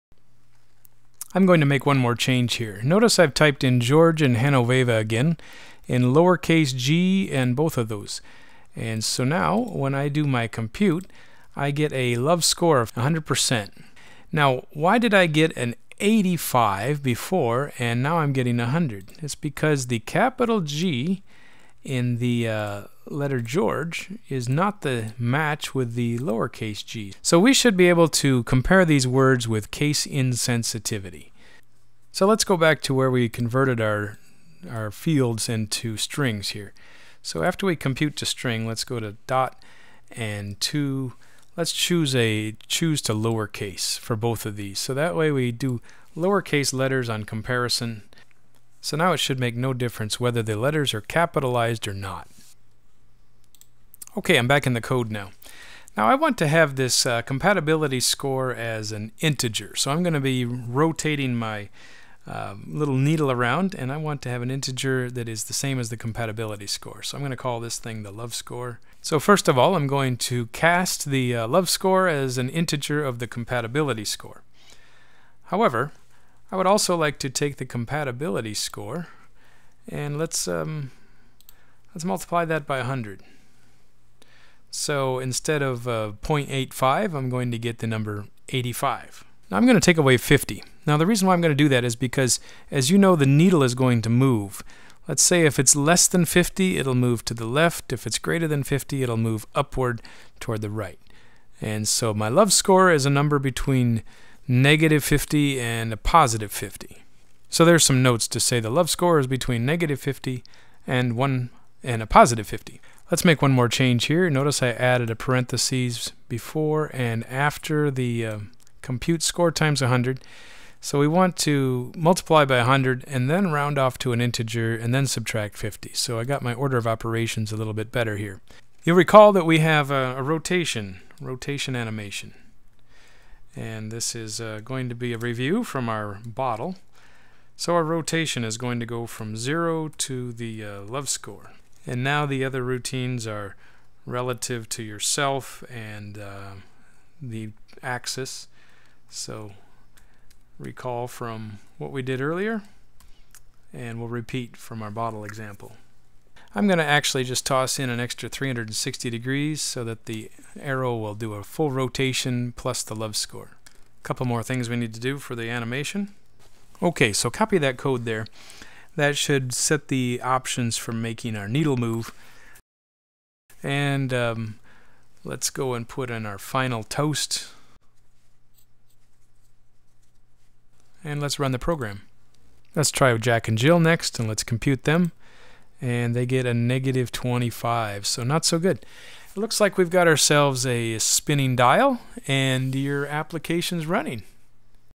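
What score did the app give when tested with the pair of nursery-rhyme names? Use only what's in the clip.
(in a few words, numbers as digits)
-25.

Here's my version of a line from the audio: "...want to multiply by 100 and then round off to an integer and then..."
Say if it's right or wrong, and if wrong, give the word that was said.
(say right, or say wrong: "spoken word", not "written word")
right.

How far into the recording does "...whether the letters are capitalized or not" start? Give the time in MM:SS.
00:50.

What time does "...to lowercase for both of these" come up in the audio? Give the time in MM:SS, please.
00:43.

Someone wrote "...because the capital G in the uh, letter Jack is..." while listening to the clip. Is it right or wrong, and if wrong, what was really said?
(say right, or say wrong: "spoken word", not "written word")
wrong: "George", not "Jack".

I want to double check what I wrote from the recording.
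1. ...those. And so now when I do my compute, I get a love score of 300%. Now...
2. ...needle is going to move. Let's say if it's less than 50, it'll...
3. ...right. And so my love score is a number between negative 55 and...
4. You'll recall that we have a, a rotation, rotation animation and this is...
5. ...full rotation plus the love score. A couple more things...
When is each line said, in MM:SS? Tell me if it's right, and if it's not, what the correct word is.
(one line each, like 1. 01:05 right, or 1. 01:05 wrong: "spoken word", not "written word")
1. 00:07 wrong: "100", not "300"
2. 01:33 right
3. 01:40 wrong: "50", not "55"
4. 02:08 right
5. 02:41 right.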